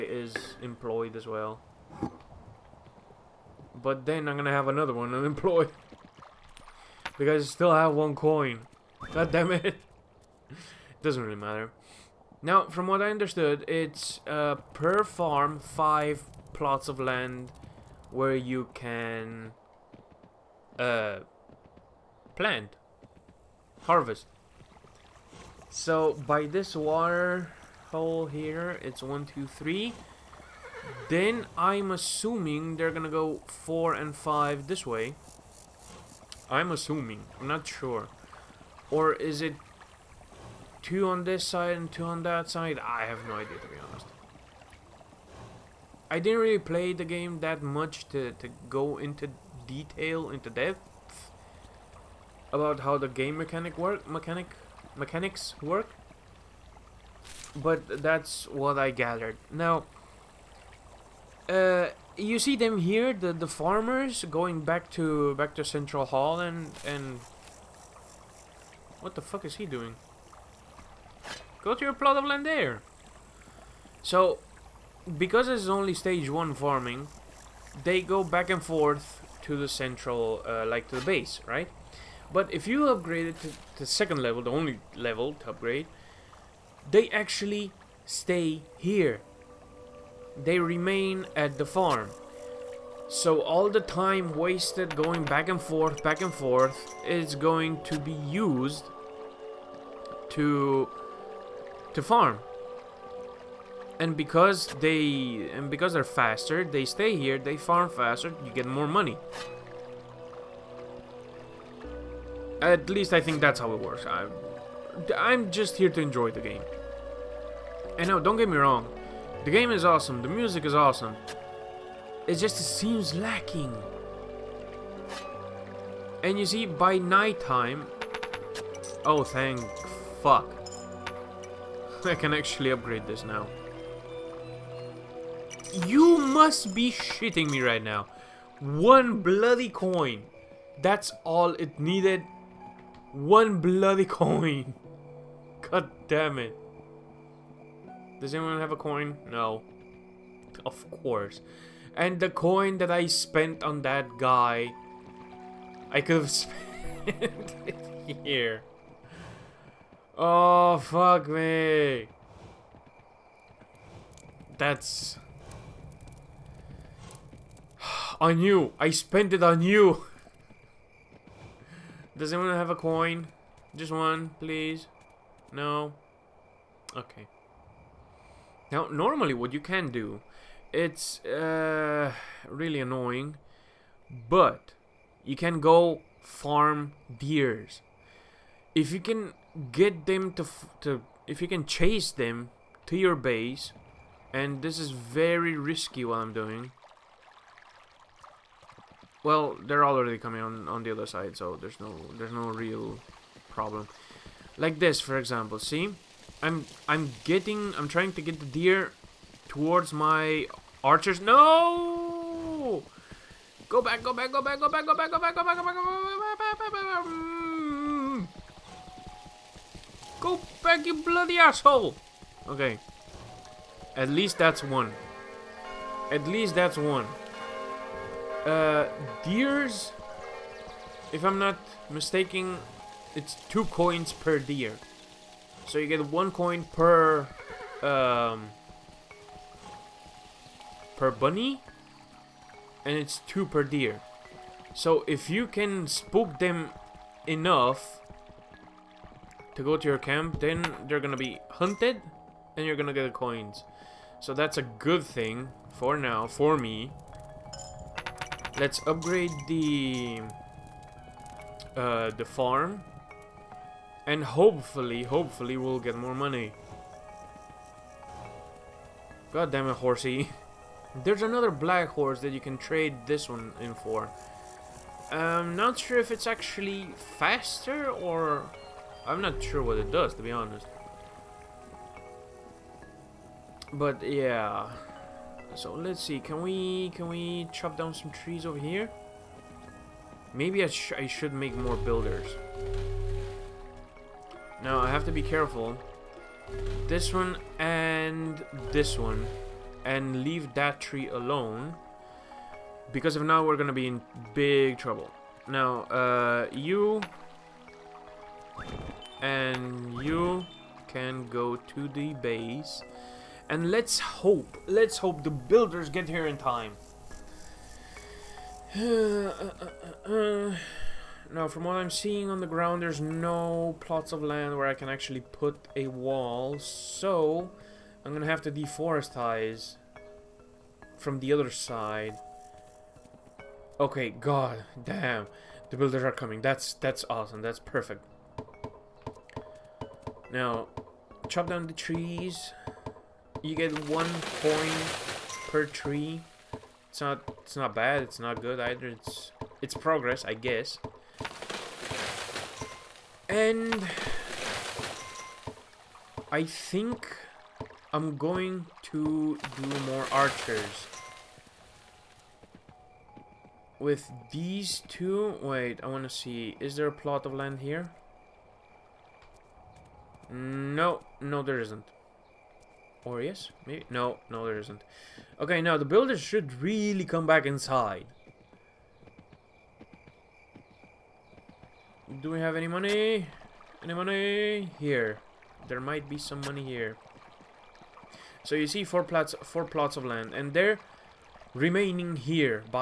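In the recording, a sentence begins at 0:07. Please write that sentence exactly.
because I still have one coin.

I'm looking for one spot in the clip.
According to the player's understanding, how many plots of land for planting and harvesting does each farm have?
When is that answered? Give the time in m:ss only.
0:15.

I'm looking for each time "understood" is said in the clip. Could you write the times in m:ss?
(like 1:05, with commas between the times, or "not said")
0:13.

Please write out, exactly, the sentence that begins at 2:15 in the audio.
You must be shitting me right now.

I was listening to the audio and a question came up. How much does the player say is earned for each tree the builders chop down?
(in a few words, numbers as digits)
1 coin.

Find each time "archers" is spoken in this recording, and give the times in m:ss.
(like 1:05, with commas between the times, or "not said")
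3:30, 6:00.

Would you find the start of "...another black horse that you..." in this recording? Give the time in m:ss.
4:31.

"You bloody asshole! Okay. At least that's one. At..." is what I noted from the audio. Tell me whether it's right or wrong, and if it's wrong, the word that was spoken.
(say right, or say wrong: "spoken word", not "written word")
right.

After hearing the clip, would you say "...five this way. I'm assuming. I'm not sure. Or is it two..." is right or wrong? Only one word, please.
right.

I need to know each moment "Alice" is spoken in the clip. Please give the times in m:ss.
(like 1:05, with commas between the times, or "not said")
not said.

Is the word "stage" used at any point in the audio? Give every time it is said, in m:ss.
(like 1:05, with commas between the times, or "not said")
1:15.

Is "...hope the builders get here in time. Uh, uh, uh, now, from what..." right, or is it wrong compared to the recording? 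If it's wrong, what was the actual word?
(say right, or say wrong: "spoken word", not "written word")
right.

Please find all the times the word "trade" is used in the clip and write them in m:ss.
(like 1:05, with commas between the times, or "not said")
4:32.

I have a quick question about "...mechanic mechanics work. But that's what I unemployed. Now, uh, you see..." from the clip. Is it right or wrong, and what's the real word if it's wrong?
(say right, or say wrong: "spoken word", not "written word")
wrong: "gathered", not "unemployed".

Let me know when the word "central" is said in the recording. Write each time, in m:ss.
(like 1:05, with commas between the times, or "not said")
1:05, 1:19.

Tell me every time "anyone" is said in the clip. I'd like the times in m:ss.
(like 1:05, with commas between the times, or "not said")
2:28, 2:52.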